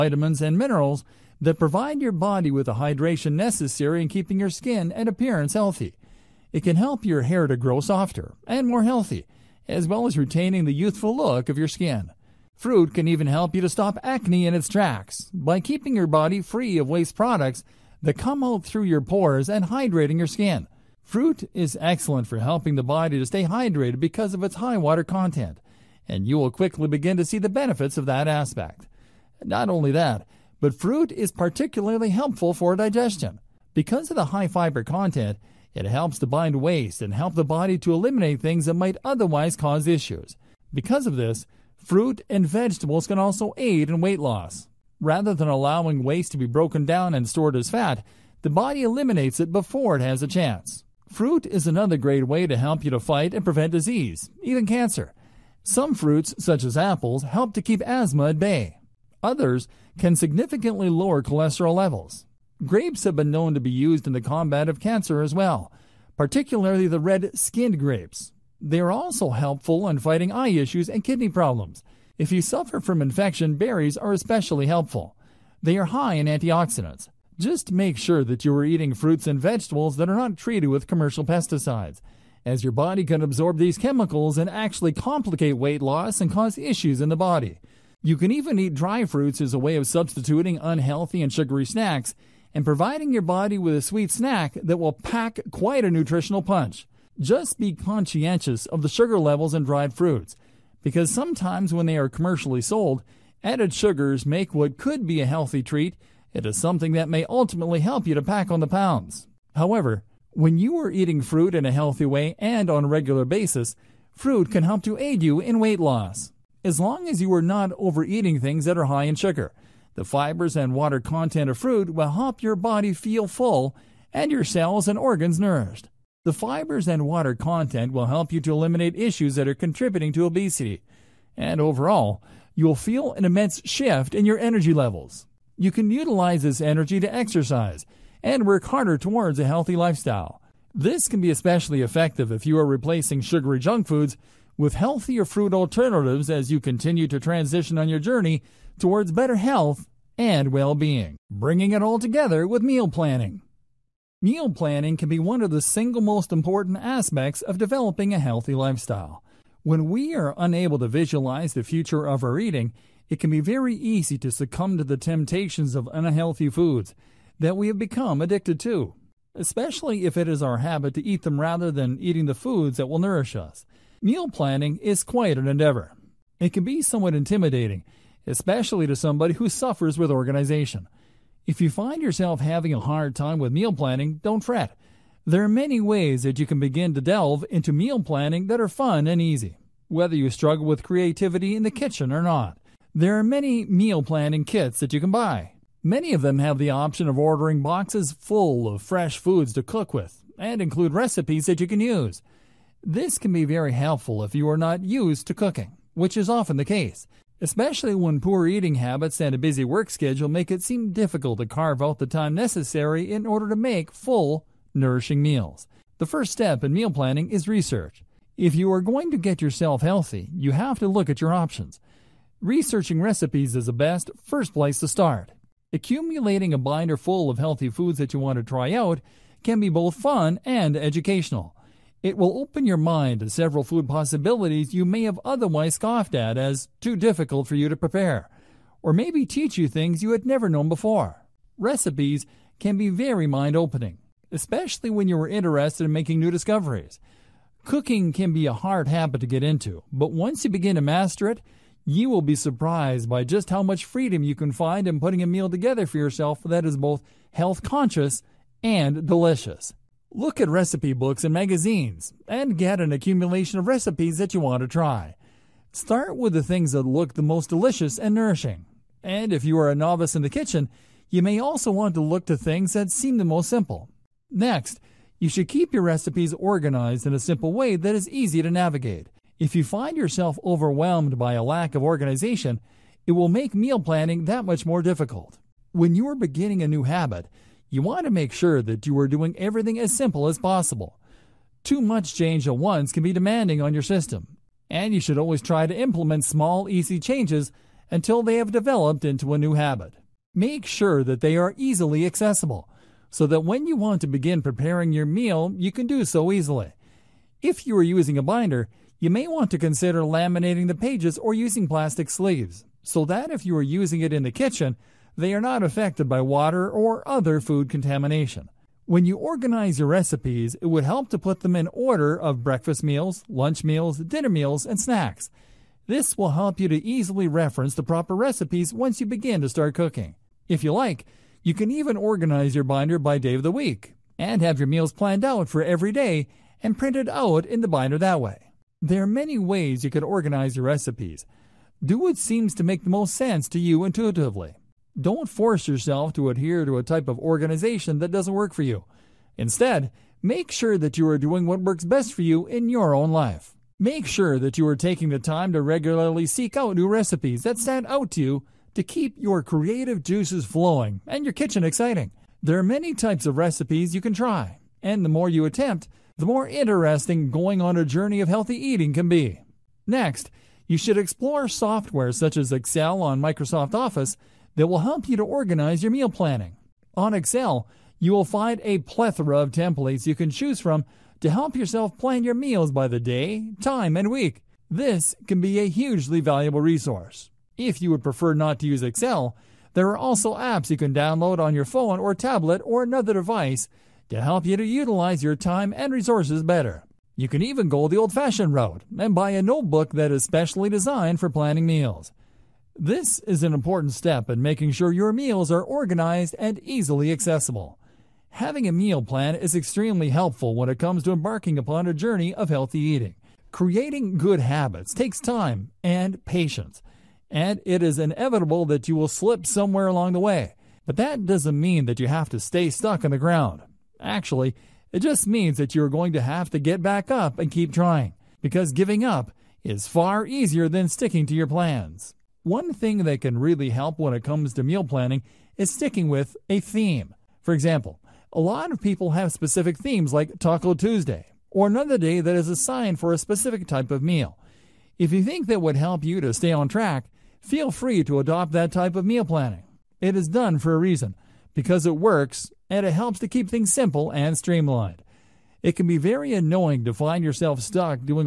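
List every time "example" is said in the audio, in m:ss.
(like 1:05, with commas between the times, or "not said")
7:17.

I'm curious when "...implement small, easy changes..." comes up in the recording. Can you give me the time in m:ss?
4:55.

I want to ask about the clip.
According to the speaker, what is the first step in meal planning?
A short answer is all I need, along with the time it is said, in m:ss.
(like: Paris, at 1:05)
research, at 3:37.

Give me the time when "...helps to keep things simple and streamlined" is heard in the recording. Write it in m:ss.
7:32.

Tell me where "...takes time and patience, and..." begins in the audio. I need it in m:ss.
6:54.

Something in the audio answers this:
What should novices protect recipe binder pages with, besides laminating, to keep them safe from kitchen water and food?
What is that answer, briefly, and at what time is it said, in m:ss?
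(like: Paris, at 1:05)
plastic sleeves, at 5:11.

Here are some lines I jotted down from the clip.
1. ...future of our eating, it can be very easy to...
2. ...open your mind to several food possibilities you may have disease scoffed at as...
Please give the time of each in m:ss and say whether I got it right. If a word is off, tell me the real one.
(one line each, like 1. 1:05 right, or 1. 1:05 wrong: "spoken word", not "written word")
1. 2:41 right
2. 3:52 wrong: "otherwise", not "disease".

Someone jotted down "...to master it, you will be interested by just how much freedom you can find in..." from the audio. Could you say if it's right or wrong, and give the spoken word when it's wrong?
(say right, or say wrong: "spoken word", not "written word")
wrong: "surprised", not "interested".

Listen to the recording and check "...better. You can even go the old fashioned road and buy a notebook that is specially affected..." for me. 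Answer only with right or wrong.
wrong.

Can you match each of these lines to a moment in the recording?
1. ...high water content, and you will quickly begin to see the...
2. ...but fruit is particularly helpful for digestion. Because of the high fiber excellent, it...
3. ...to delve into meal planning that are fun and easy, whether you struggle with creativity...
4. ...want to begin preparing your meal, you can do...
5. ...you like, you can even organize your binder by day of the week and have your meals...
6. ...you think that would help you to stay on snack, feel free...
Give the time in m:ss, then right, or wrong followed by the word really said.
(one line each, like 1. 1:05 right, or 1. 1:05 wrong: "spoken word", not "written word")
1. 0:24 right
2. 0:30 wrong: "content", not "excellent"
3. 3:06 right
4. 5:03 right
5. 5:30 right
6. 7:25 wrong: "track", not "snack".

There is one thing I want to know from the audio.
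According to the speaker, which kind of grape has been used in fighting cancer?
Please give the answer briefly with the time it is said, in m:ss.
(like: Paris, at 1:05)
red skinned grapes, at 1:06.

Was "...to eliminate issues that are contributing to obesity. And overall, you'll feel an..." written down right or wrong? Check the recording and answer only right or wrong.
right.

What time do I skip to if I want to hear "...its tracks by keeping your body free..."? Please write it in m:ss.
0:14.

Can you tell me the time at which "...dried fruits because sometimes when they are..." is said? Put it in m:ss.
1:39.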